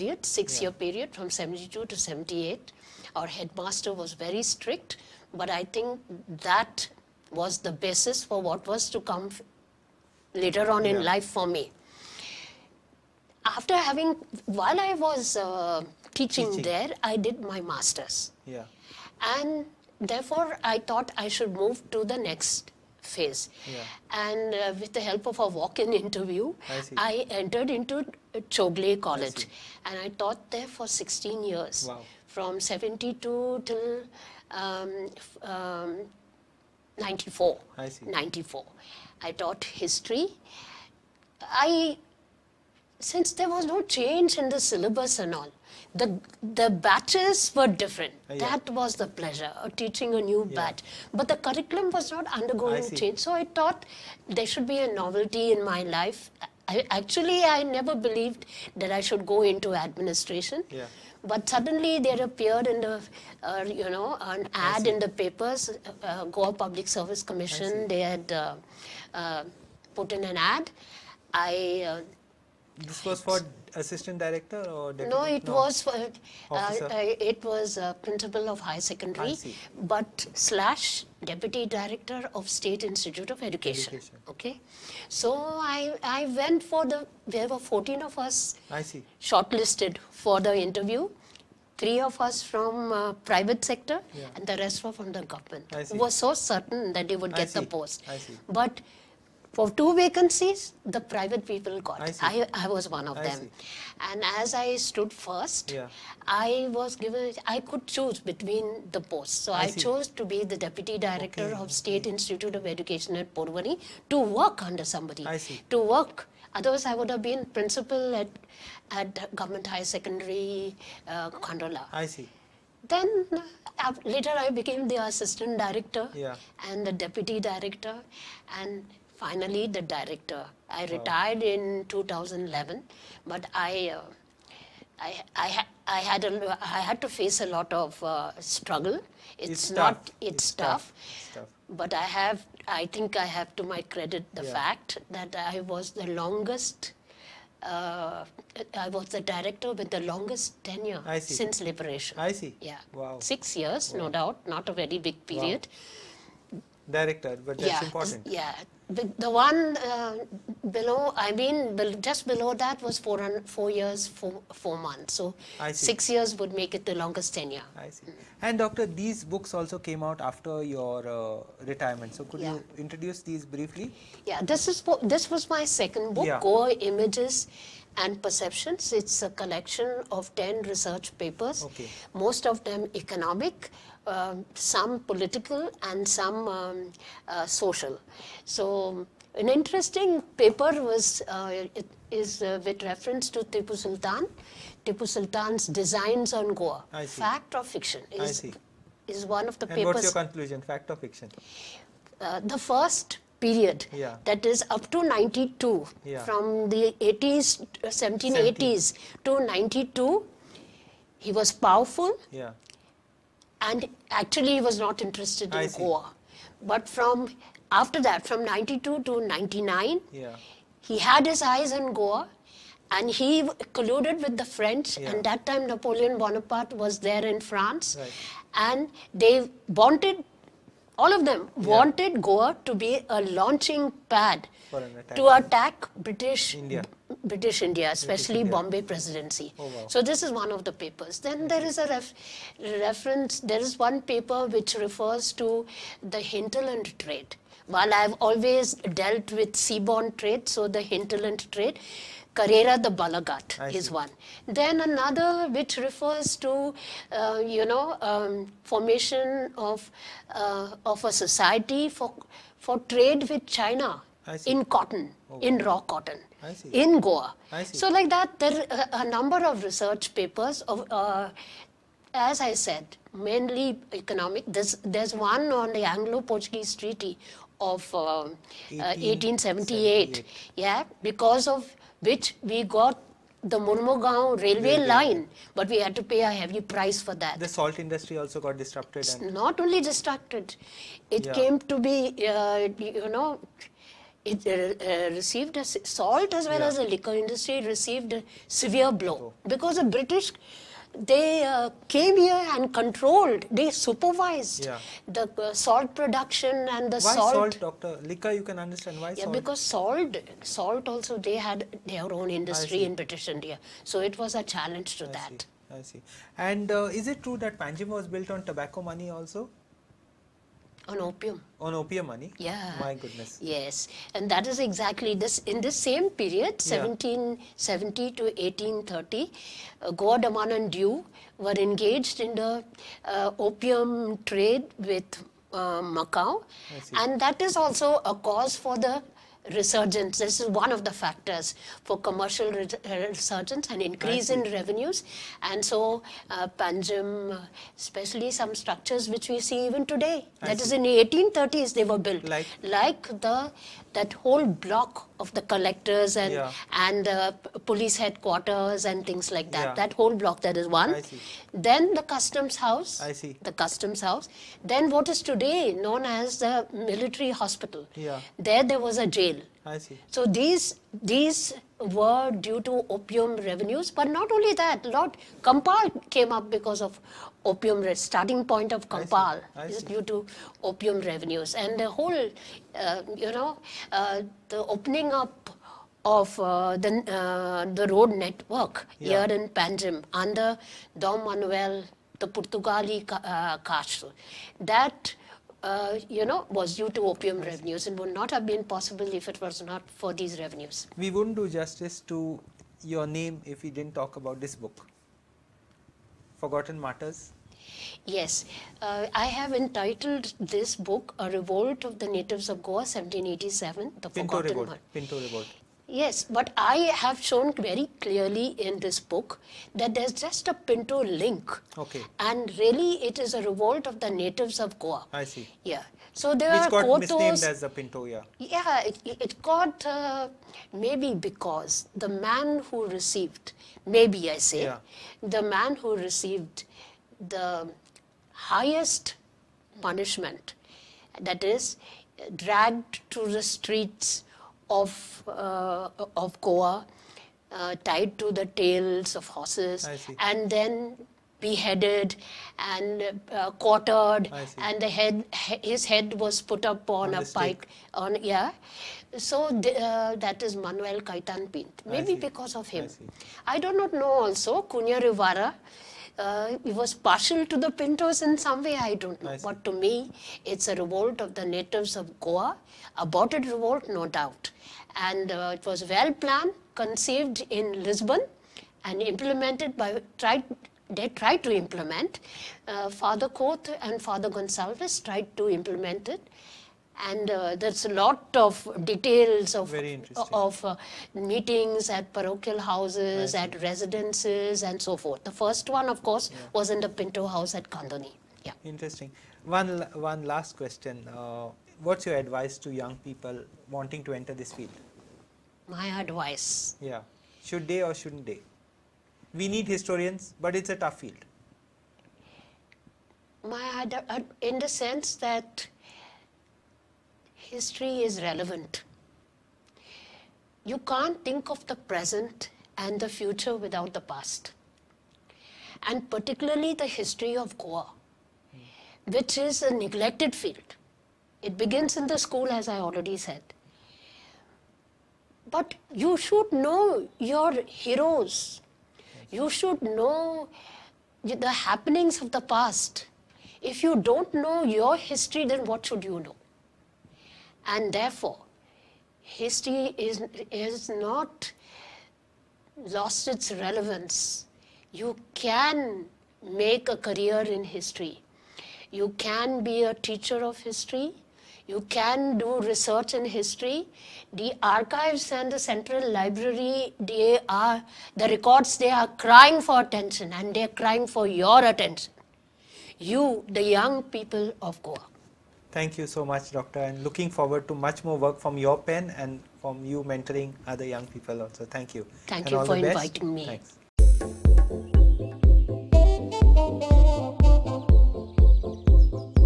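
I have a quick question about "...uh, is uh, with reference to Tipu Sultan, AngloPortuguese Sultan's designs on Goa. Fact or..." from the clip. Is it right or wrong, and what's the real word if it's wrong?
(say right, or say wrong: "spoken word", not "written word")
wrong: "Tipu", not "AngloPortuguese".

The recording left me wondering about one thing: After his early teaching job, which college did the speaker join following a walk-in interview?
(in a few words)
Chowgule College.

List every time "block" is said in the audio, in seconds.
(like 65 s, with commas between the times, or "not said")
354 s, 360 s.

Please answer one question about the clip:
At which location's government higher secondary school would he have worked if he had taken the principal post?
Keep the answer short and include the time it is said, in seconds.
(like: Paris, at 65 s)
Khandola, at 121 s.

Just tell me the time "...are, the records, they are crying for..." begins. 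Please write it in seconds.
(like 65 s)
567 s.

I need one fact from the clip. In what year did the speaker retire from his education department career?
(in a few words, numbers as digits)
2011.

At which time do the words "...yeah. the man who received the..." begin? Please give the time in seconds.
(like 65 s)
434 s.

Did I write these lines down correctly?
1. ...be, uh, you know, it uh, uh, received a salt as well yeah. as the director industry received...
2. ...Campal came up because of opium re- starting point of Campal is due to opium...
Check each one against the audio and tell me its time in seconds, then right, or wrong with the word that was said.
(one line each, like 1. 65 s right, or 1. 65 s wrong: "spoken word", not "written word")
1. 291 s wrong: "liquor", not "director"
2. 375 s right.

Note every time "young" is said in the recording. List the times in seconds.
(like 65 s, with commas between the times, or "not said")
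502 s, 573 s, 580 s.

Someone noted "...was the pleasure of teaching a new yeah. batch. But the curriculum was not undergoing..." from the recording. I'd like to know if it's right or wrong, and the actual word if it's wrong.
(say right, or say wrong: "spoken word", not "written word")
right.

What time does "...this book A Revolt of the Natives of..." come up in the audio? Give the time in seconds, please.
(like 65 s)
410 s.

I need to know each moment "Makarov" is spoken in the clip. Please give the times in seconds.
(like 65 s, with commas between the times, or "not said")
not said.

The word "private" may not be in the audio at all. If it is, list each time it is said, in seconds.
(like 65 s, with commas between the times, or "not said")
93 s, 101 s.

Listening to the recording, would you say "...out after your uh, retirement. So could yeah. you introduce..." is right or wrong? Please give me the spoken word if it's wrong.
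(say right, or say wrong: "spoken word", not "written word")
right.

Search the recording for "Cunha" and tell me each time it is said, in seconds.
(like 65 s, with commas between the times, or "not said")
464 s.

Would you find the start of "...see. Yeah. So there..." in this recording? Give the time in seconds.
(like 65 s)
425 s.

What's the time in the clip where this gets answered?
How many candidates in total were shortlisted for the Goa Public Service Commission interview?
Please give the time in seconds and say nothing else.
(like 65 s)
87 s.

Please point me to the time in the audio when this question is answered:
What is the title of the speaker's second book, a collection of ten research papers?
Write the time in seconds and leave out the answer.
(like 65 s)
176 s.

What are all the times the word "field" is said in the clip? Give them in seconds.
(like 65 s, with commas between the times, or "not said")
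504 s, 511 s, 530 s.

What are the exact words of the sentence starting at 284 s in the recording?
line, but we had to pay a heavy price for that.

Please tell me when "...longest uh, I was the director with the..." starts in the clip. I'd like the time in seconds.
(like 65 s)
146 s.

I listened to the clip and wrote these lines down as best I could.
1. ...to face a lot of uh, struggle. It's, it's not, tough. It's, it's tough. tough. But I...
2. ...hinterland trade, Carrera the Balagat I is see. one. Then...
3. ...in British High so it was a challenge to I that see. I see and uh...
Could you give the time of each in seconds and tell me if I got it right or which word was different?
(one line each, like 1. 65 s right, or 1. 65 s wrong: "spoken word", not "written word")
1. 137 s right
2. 250 s right
3. 312 s wrong: "India", not "High".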